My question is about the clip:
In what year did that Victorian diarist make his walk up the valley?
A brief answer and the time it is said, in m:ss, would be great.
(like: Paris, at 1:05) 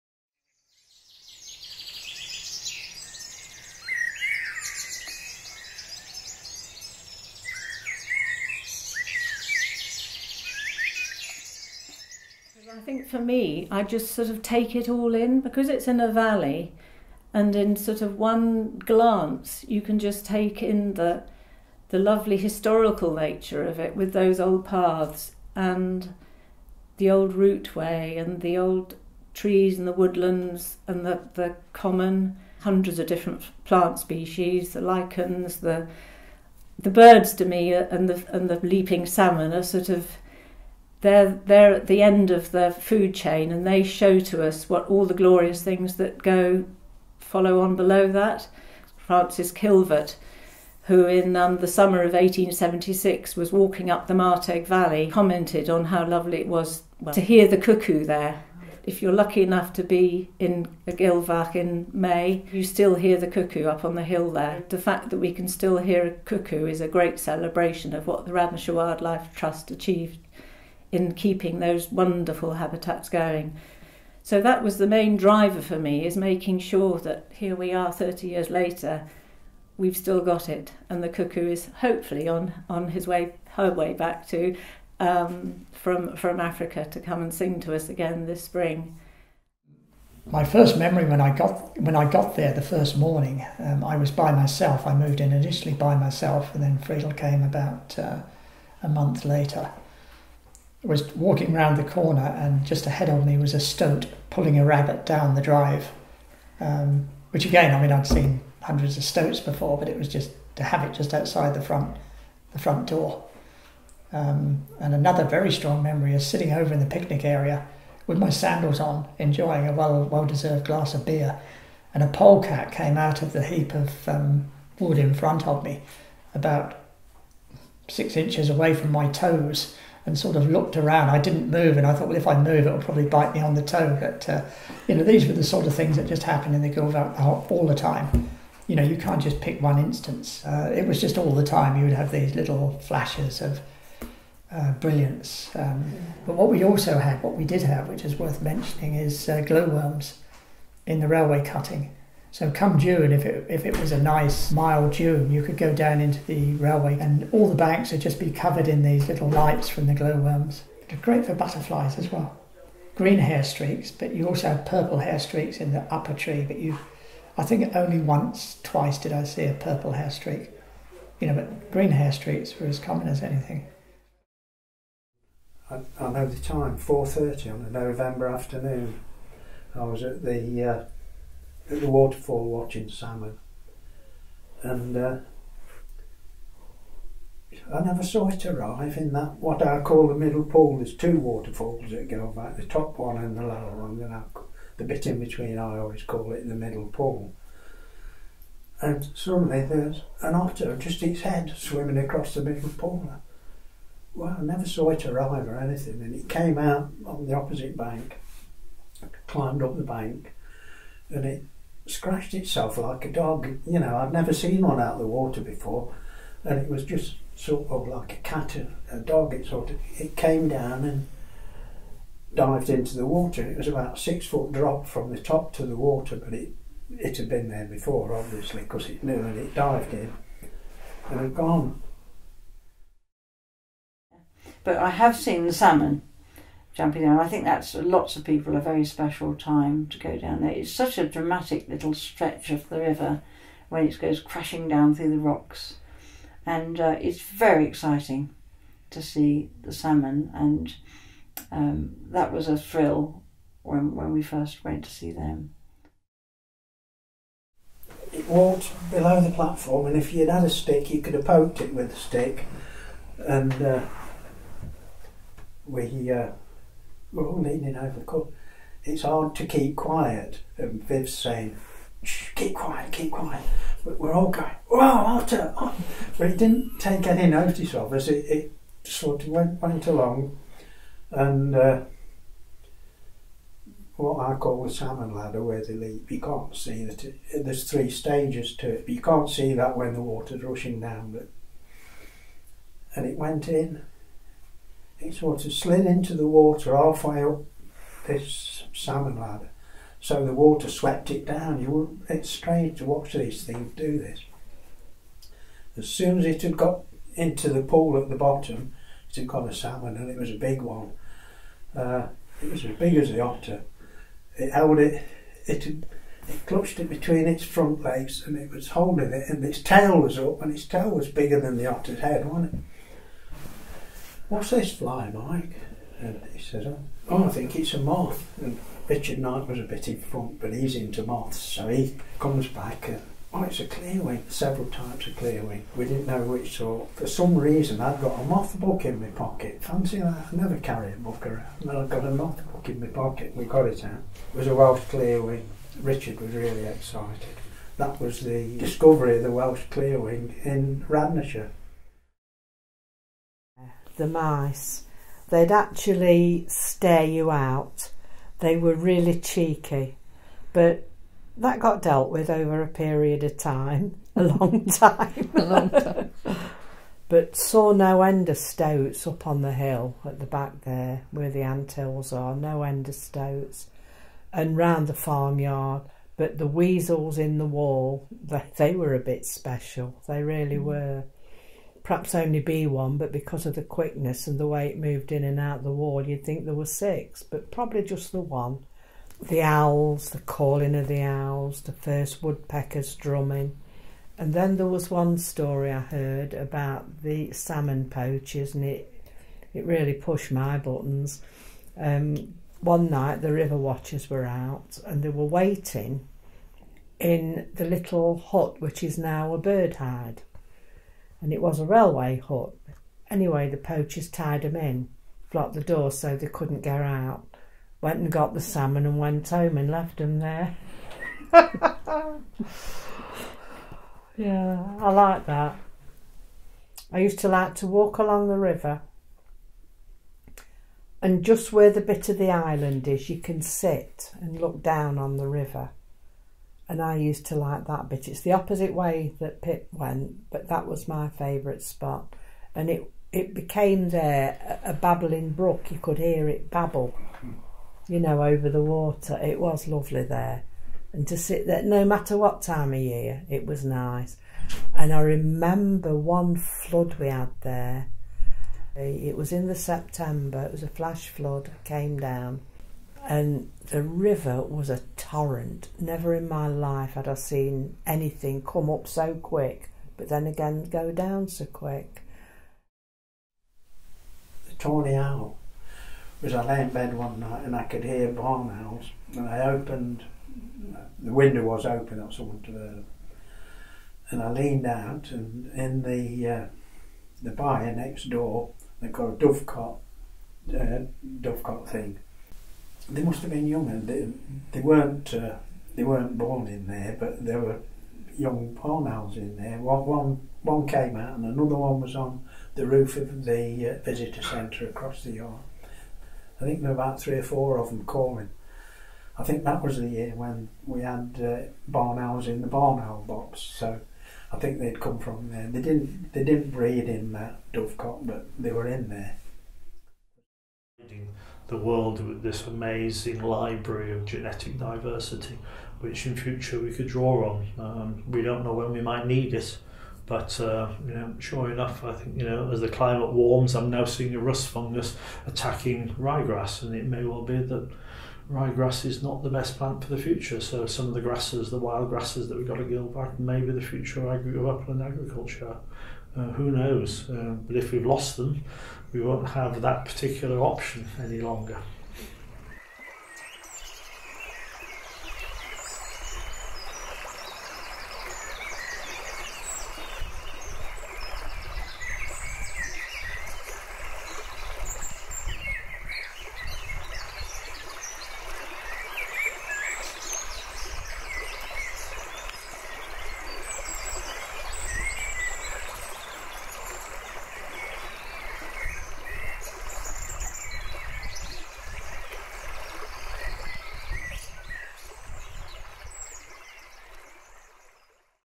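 1876, at 0:52.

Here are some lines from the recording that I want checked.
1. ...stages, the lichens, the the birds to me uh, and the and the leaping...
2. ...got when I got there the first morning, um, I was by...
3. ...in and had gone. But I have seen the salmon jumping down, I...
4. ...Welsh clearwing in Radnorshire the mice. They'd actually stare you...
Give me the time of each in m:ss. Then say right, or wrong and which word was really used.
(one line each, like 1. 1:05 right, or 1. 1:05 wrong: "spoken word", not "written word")
1. 0:33 wrong: "species", not "stages"
2. 1:31 right
3. 3:49 right
4. 5:49 right.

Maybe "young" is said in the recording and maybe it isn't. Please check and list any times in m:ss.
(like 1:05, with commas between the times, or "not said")
8:13, 8:18.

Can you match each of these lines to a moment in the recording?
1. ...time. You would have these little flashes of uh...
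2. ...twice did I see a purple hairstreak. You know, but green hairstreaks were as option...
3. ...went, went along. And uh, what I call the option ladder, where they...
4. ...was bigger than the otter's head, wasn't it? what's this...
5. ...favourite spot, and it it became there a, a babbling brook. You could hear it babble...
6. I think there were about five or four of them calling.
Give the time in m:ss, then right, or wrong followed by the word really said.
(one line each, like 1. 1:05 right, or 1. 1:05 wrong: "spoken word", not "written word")
1. 2:21 right
2. 2:48 wrong: "common", not "option"
3. 4:39 wrong: "salmon", not "option"
4. 5:20 right
5. 7:21 right
6. 8:26 wrong: "three", not "five".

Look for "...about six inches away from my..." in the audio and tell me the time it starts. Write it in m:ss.
2:06.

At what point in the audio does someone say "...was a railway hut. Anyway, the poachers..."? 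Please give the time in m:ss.
6:51.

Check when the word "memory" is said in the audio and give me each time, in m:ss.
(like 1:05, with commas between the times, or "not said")
1:30, 1:55.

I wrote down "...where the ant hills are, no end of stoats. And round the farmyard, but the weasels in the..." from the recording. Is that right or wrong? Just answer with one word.
right.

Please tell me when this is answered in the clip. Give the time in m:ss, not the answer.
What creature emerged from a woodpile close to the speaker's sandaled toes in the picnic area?
2:02.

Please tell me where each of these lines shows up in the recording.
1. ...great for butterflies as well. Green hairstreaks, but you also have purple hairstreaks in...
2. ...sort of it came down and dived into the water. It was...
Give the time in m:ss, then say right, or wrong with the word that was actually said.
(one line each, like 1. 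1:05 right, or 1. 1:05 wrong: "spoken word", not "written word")
1. 2:40 right
2. 3:39 right.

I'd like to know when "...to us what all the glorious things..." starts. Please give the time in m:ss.
0:44.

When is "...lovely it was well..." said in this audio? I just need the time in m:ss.
0:56.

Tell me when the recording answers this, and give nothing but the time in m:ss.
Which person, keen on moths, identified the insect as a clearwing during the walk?
5:28.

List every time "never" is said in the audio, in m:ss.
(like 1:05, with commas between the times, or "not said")
3:07, 3:24, 3:34, 5:40, 7:45.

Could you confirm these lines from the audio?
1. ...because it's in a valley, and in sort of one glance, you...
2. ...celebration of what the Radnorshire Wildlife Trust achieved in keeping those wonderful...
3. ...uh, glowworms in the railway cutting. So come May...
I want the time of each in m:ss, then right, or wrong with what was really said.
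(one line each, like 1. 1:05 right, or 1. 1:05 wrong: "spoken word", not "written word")
1. 0:15 right
2. 1:07 right
3. 2:29 wrong: "June", not "May".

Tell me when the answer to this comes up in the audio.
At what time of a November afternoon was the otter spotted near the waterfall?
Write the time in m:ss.
2:56.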